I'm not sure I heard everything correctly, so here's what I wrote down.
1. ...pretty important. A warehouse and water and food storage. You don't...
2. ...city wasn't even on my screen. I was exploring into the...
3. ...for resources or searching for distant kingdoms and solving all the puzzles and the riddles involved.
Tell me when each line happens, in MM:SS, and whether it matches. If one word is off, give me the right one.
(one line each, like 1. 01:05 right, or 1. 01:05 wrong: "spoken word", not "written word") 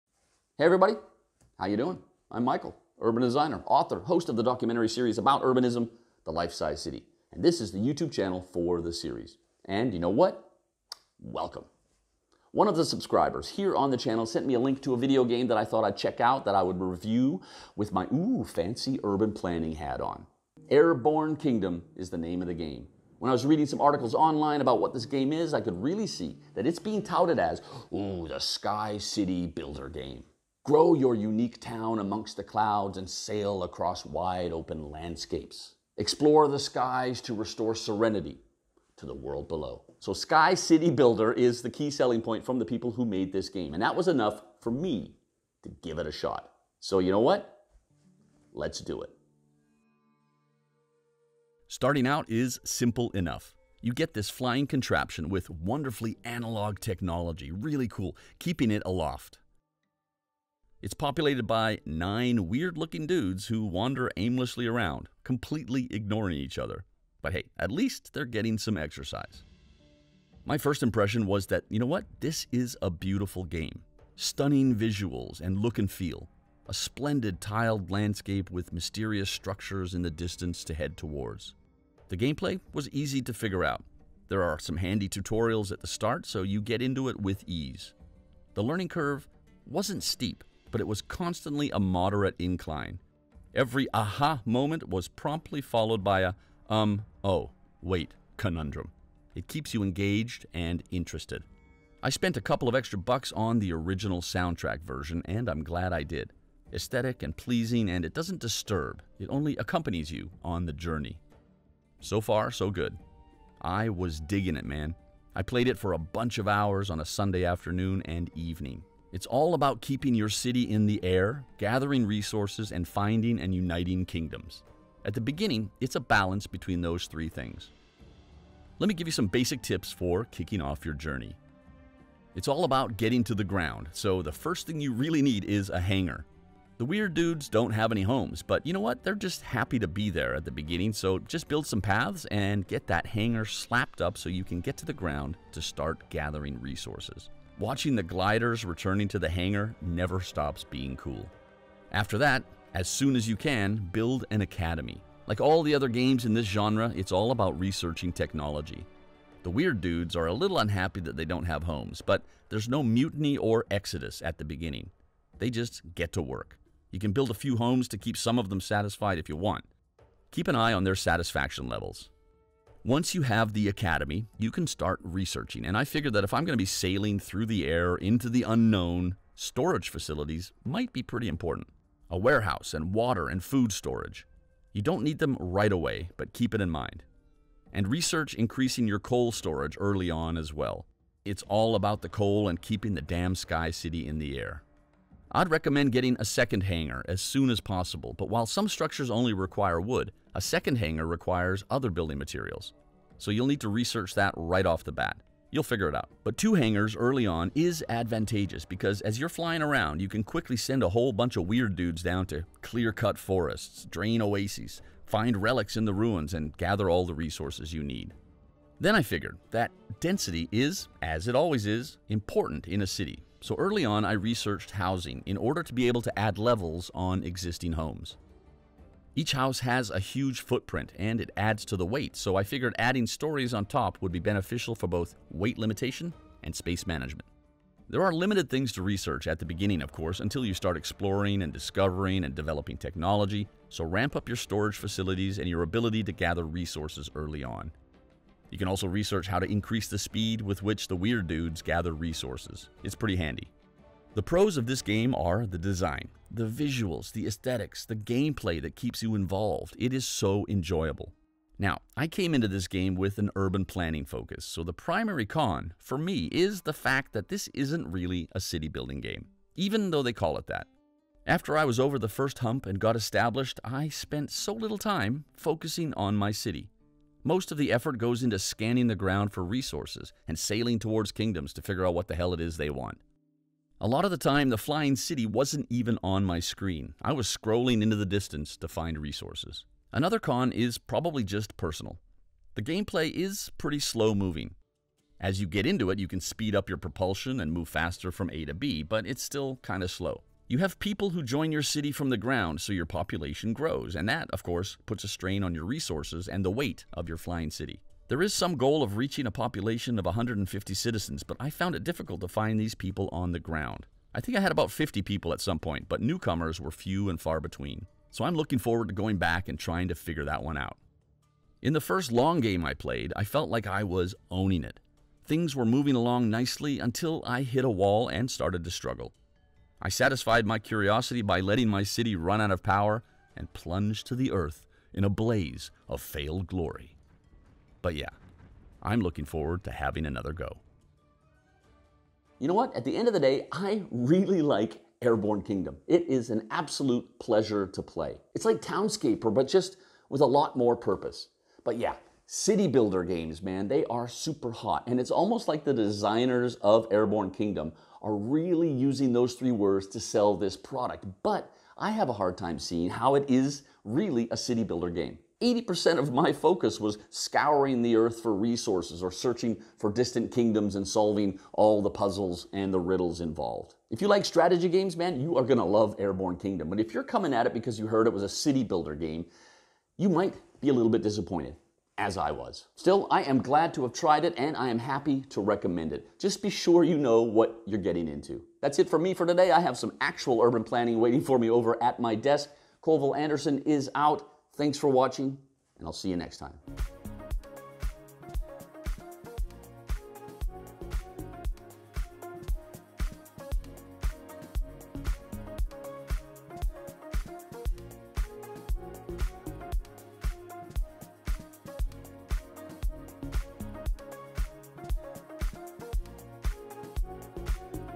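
1. 03:01 right
2. 04:44 wrong: "scrolling", not "exploring"
3. 06:08 right.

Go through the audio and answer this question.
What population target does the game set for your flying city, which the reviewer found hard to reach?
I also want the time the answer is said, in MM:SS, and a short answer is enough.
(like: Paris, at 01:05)
150 citizens, at 05:10.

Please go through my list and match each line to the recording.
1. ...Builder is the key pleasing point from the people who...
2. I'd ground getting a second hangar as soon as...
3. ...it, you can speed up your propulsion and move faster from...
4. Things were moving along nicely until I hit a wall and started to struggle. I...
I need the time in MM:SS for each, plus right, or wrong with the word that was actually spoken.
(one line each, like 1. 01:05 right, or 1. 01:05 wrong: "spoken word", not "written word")
1. 00:40 wrong: "selling", not "pleasing"
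2. 03:15 wrong: "recommend", not "ground"
3. 04:55 right
4. 05:25 right.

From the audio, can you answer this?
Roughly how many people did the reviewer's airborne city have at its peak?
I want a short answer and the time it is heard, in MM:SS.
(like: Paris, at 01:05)
about 50, at 05:14.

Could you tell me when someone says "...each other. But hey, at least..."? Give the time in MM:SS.
01:06.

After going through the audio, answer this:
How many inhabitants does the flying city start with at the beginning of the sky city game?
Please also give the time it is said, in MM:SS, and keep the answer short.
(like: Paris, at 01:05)
9, at 01:01.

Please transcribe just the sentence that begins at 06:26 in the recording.
Just be sure you know what you're getting into.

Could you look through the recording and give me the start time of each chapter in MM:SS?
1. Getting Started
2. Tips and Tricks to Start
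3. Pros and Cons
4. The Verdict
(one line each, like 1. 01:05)
1. 00:50
2. 02:08
3. 04:13
4. 05:41.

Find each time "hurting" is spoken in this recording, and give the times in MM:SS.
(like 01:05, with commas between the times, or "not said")
not said.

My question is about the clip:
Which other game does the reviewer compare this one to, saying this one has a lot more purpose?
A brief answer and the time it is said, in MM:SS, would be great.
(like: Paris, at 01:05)
Townscaper, at 05:48.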